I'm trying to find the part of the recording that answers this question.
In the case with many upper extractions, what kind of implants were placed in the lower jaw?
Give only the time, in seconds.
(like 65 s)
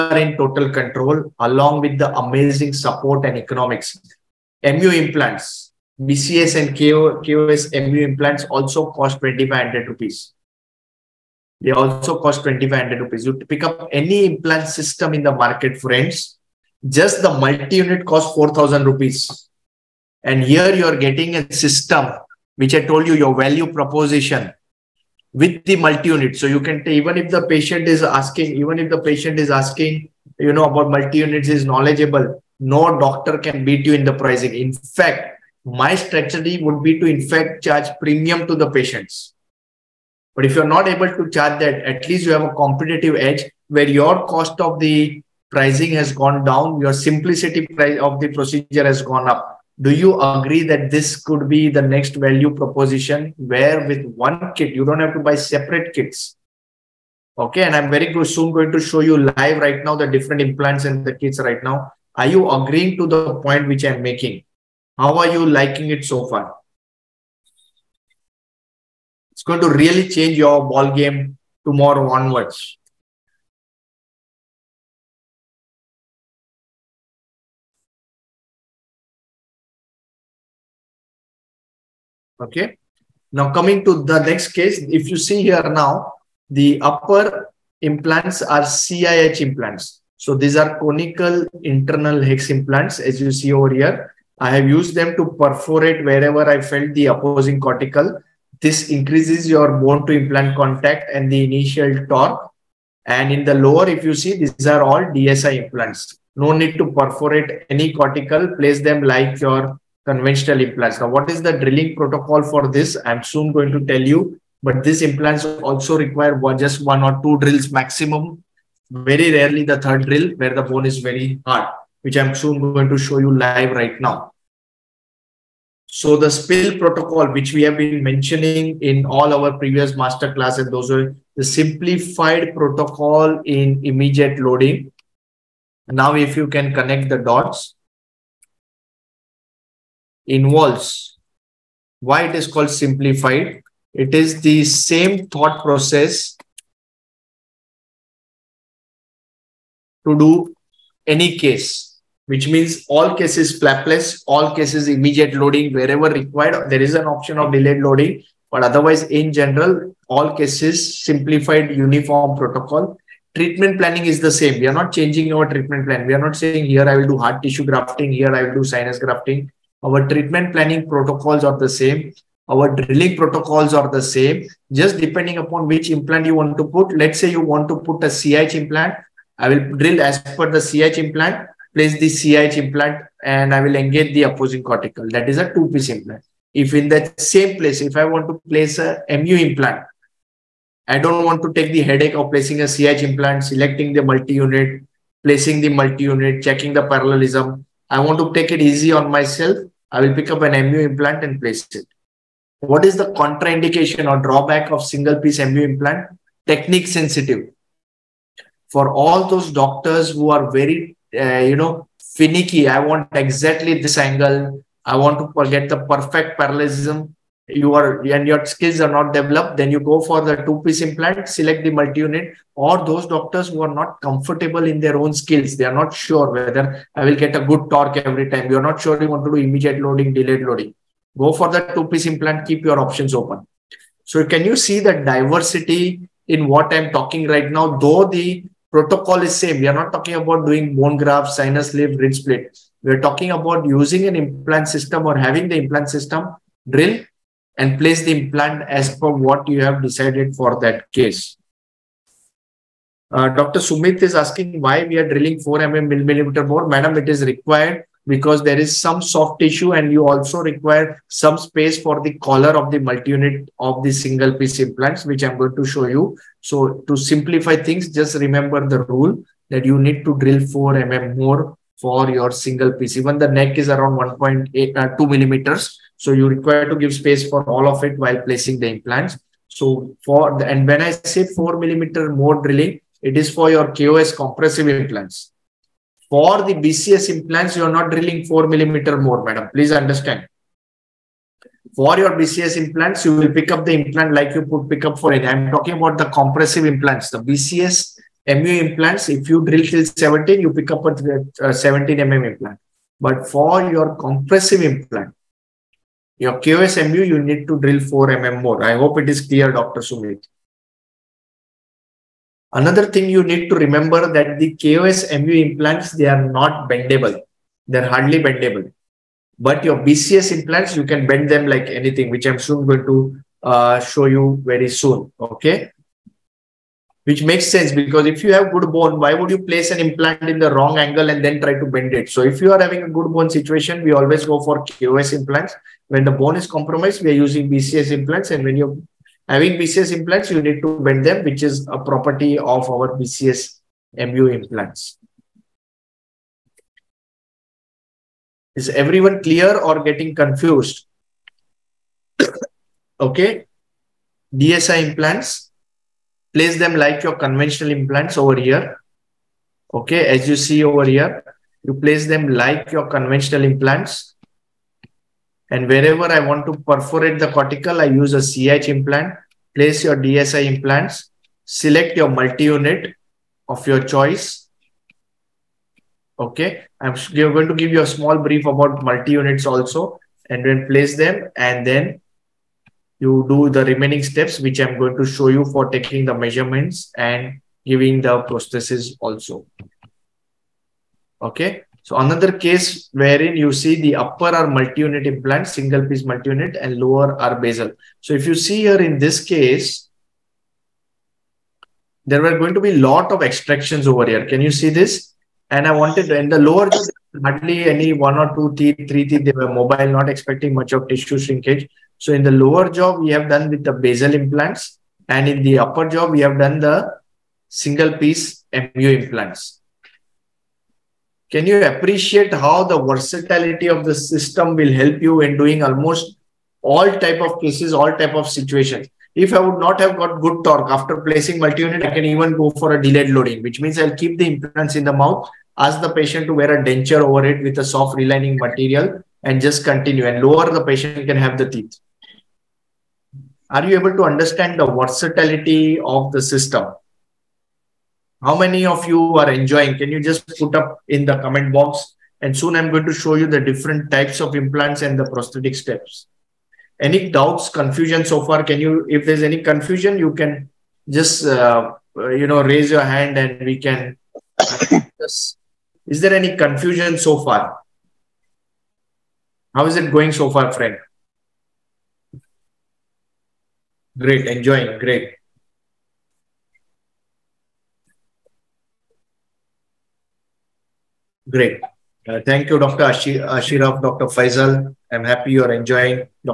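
413 s.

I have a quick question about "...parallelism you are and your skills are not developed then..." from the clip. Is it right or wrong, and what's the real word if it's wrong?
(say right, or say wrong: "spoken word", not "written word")
right.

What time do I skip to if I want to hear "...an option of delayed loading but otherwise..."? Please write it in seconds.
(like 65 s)
156 s.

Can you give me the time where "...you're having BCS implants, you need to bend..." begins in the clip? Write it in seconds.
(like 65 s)
338 s.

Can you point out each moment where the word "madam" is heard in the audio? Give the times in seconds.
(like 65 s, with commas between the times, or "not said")
256 s, 289 s.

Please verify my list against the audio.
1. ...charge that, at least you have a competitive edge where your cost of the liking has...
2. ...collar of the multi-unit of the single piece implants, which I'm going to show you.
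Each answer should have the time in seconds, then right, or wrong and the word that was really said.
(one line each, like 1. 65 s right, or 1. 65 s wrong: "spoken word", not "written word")
1. 41 s wrong: "pricing", not "liking"
2. 262 s right.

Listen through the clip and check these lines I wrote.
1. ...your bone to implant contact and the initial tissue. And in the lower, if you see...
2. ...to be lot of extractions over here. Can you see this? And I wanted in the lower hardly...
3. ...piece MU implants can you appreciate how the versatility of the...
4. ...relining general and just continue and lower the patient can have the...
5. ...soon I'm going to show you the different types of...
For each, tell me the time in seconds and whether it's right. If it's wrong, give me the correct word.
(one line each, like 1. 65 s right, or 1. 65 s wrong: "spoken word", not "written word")
1. 99 s wrong: "torque", not "tissue"
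2. 402 s right
3. 417 s right
4. 438 s wrong: "material", not "general"
5. 452 s right.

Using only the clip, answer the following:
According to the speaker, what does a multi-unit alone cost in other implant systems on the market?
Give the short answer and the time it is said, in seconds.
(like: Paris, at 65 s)
4000 rupees, at 18 s.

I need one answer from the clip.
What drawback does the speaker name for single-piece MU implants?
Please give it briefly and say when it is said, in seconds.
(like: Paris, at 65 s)
Technique sensitive, at 206 s.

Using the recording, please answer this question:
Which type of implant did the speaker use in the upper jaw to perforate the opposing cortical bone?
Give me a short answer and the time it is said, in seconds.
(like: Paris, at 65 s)
CIH implants, at 88 s.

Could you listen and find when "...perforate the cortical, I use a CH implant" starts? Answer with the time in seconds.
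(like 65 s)
366 s.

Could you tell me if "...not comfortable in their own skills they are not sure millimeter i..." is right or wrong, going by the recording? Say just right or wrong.
wrong.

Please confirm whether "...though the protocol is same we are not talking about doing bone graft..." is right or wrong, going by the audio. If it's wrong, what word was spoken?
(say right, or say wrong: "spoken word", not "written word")
right.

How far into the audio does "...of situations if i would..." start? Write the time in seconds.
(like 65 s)
428 s.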